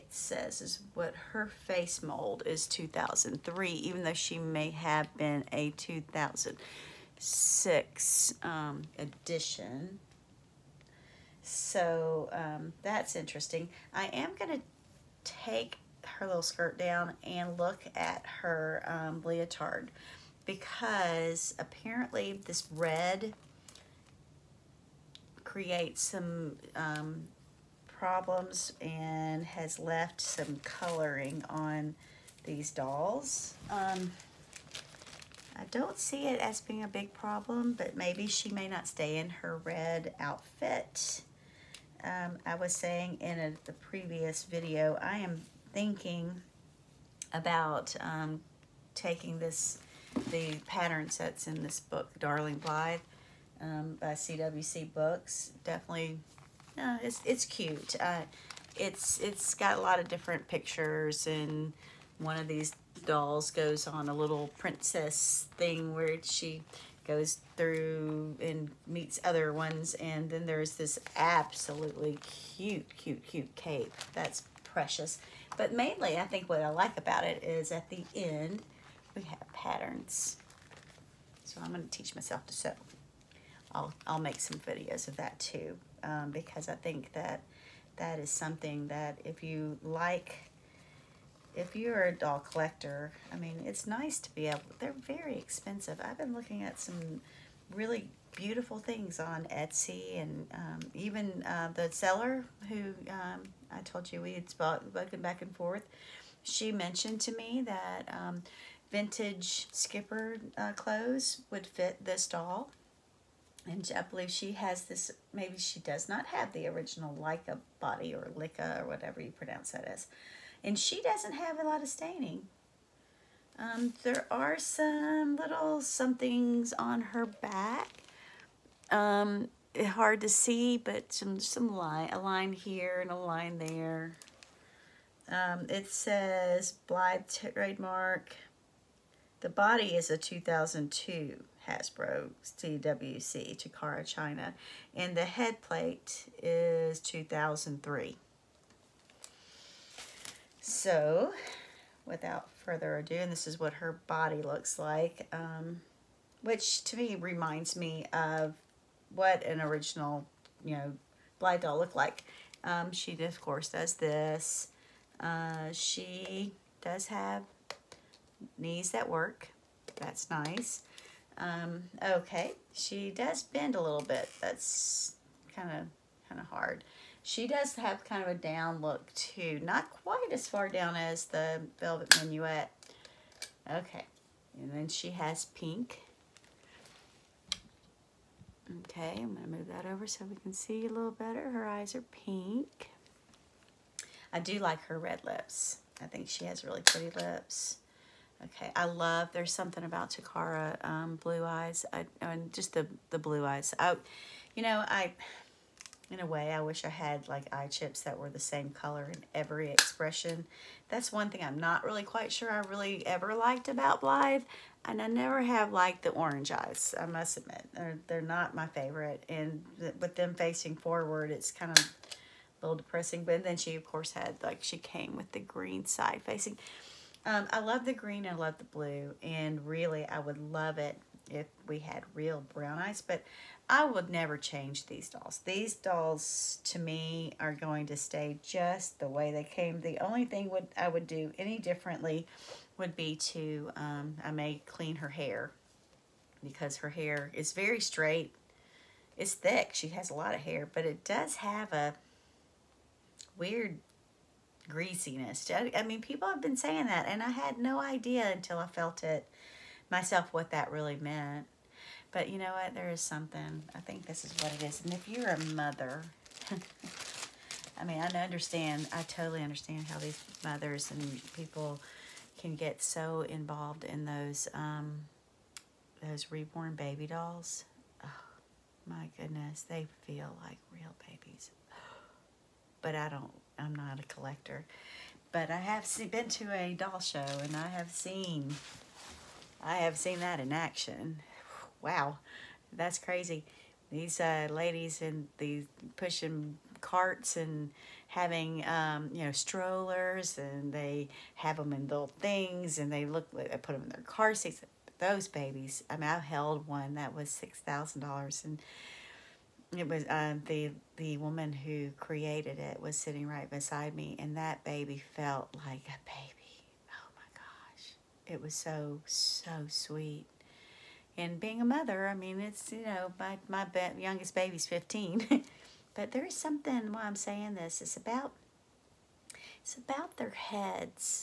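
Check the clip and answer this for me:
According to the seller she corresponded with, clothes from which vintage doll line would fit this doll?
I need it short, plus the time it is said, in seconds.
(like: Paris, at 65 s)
Skipper, at 108 s.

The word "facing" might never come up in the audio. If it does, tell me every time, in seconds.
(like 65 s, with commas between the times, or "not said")
220 s, 226 s.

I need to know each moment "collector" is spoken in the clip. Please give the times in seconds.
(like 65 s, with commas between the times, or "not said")
92 s, 284 s.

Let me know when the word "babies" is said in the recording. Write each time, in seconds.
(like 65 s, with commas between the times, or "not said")
281 s, 305 s.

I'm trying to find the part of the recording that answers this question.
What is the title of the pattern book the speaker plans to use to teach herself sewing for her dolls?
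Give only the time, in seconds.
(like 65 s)
52 s.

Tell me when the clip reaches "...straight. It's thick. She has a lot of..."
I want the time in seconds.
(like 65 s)
247 s.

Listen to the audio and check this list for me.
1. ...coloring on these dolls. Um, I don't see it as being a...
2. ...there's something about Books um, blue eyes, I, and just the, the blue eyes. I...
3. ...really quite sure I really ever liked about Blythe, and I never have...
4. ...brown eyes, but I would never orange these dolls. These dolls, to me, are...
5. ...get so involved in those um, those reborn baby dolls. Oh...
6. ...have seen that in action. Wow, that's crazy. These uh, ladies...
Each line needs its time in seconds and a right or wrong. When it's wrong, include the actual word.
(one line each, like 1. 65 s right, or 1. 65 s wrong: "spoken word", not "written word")
1. 30 s right
2. 199 s wrong: "Takara", not "Books"
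3. 211 s right
4. 232 s wrong: "change", not "orange"
5. 272 s right
6. 289 s right.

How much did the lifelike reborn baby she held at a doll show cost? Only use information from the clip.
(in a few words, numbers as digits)
$6,000.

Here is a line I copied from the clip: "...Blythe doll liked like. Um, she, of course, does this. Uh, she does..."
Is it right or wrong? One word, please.
wrong.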